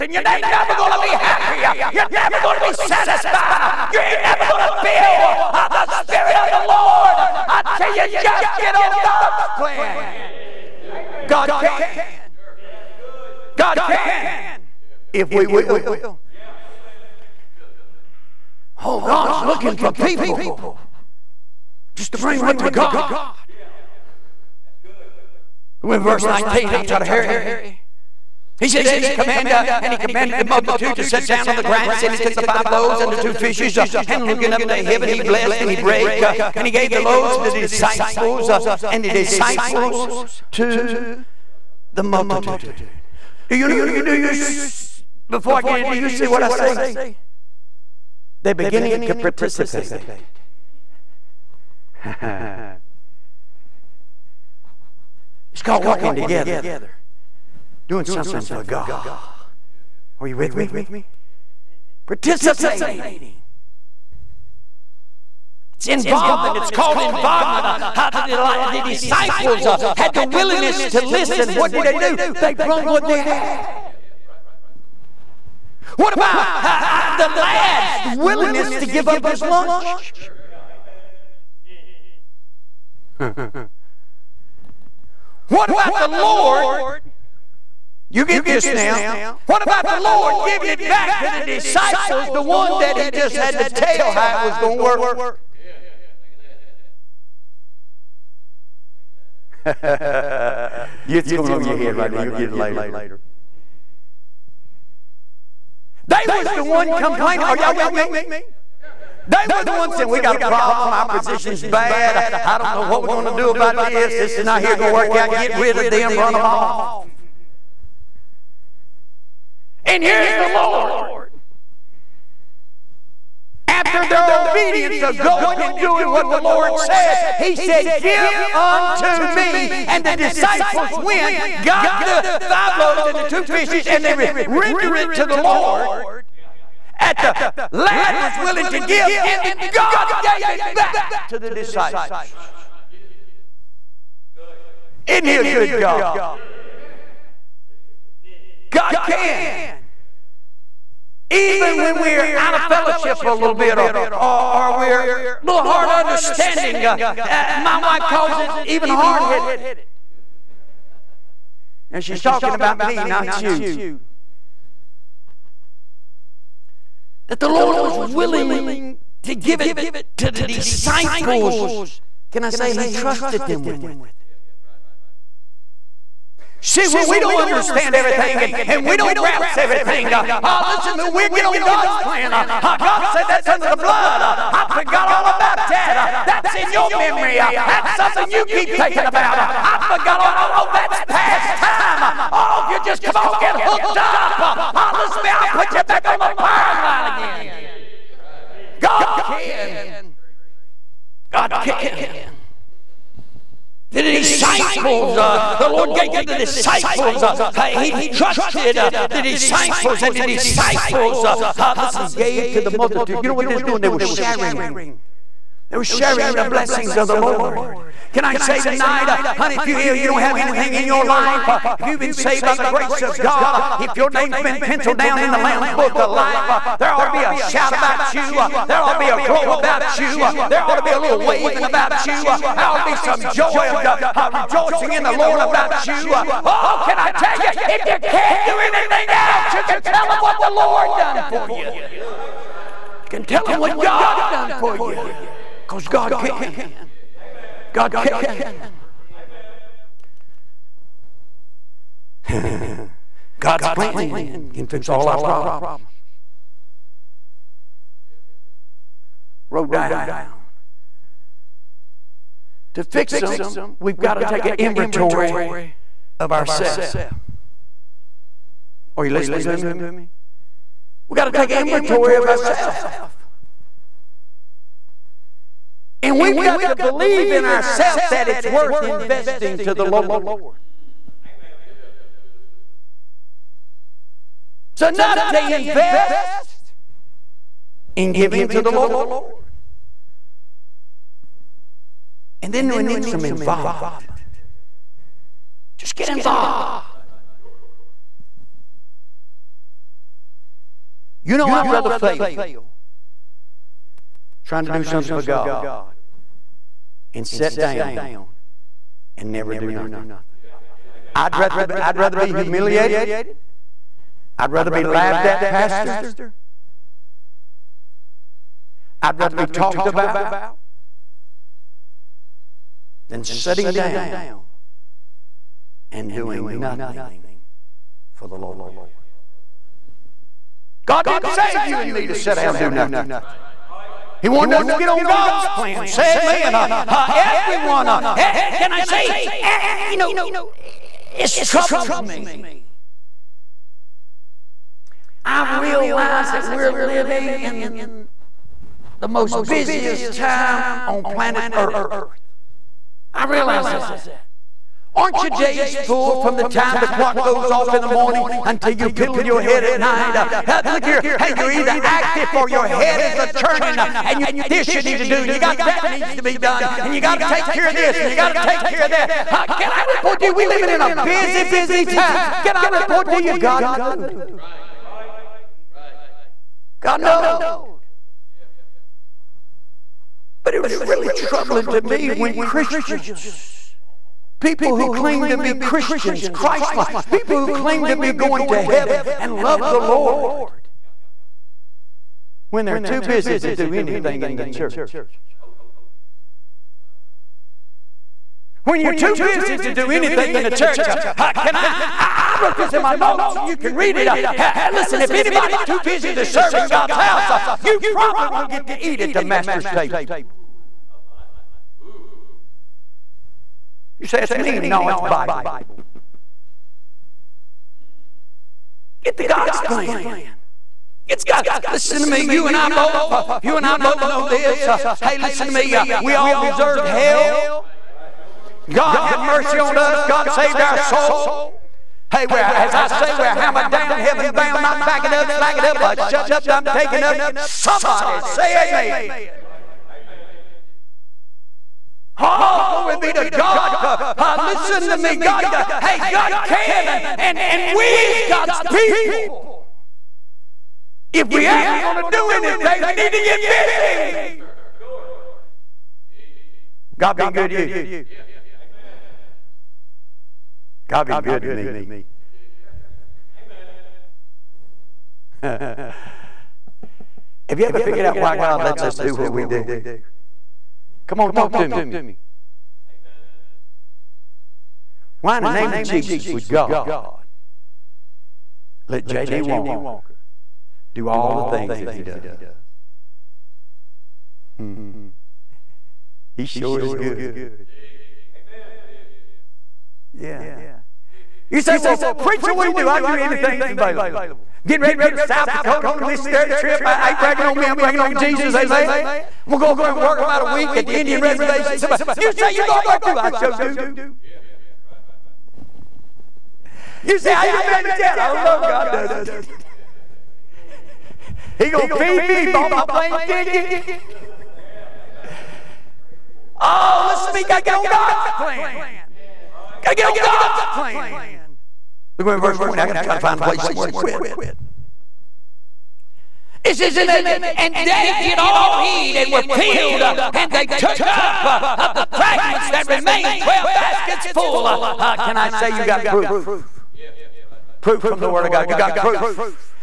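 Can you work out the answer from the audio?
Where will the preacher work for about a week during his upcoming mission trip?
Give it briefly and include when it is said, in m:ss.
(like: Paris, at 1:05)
Indian reservation, at 8:20.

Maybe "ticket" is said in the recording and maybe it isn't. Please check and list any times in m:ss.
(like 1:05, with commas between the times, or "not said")
8:33.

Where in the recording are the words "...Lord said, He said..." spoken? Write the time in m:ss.
2:06.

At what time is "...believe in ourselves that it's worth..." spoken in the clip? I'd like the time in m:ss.
4:36.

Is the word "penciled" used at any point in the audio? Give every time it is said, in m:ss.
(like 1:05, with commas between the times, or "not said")
3:44.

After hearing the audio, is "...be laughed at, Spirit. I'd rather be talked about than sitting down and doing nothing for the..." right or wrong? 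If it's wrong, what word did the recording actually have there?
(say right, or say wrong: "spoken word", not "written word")
wrong: "Pastor", not "Spirit".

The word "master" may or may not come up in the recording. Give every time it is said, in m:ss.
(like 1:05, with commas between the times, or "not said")
6:49.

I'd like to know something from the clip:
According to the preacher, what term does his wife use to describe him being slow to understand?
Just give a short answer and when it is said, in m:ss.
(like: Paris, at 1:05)
hard headed, at 2:38.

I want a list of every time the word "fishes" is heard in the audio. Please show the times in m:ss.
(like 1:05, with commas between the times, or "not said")
0:33, 2:13.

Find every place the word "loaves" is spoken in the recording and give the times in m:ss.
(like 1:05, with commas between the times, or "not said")
0:32, 0:37, 2:12.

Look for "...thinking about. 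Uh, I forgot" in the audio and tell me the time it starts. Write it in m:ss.
3:08.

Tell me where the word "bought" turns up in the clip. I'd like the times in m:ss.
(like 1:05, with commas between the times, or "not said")
8:32.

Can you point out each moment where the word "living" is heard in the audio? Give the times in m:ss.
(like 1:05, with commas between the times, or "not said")
5:46, 6:10.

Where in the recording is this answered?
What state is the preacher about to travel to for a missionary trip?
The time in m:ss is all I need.
8:15.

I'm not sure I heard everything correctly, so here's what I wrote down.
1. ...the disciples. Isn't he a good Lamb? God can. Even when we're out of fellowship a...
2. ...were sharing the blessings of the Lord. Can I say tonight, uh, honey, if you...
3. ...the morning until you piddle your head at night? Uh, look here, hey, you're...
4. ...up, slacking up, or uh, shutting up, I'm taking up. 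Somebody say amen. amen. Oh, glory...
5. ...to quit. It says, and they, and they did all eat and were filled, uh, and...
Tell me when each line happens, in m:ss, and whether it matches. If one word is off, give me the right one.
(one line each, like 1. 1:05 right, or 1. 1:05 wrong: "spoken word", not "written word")
1. 2:21 wrong: "God", not "Lamb"
2. 3:35 right
3. 5:57 right
4. 7:15 right
5. 8:43 right.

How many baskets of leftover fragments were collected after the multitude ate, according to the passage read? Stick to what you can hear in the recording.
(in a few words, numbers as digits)
12.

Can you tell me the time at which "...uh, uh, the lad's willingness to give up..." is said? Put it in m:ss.
1:16.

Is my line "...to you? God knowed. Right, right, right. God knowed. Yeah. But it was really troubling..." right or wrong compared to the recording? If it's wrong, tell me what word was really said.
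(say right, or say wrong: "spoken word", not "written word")
right.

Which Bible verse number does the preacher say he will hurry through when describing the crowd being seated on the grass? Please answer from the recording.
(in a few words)
19.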